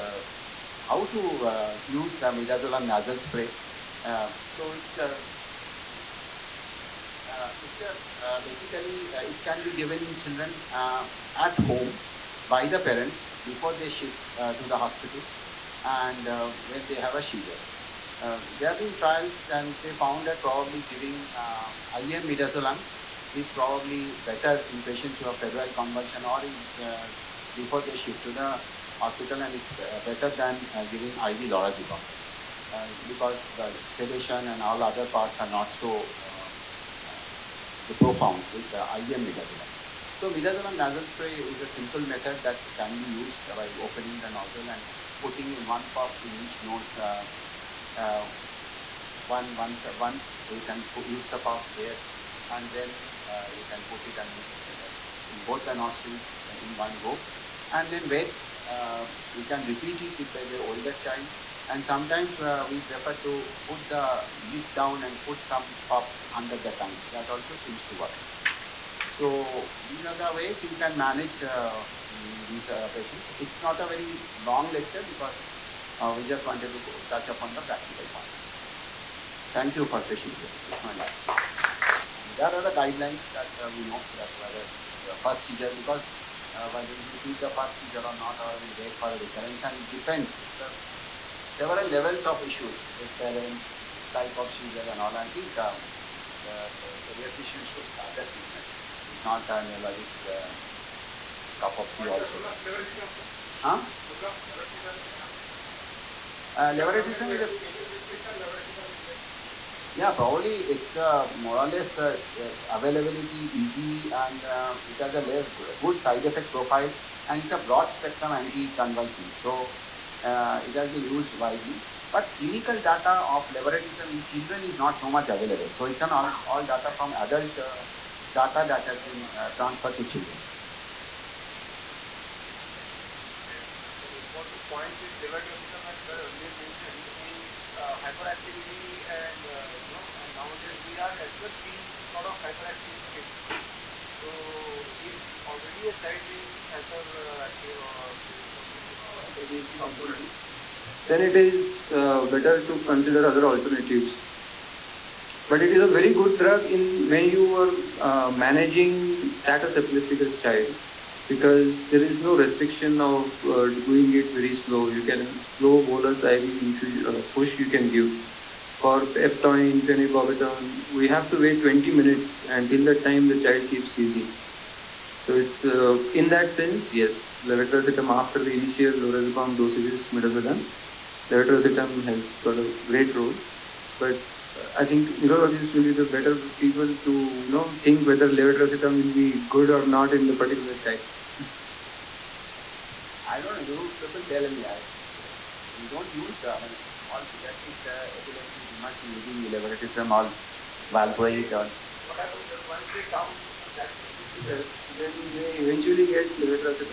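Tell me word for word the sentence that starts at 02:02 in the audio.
But clinical data of levetiracetam in children is not so much available.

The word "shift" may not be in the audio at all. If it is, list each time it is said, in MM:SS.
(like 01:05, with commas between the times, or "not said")
00:13, 00:27.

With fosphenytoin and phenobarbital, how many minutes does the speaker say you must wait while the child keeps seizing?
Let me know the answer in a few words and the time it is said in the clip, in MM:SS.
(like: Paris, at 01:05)
20, at 02:51.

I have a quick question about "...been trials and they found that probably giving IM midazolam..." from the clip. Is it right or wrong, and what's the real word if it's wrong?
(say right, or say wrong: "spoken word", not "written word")
right.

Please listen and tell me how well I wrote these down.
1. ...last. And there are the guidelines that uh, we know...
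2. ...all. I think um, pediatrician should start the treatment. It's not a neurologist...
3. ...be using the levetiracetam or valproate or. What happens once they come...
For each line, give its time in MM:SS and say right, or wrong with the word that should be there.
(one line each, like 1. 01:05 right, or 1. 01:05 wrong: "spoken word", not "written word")
1. 01:20 right
2. 01:34 right
3. 03:19 right.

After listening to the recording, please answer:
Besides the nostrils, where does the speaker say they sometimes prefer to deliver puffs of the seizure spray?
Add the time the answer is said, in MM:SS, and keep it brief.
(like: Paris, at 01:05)
Under the tongue, at 01:06.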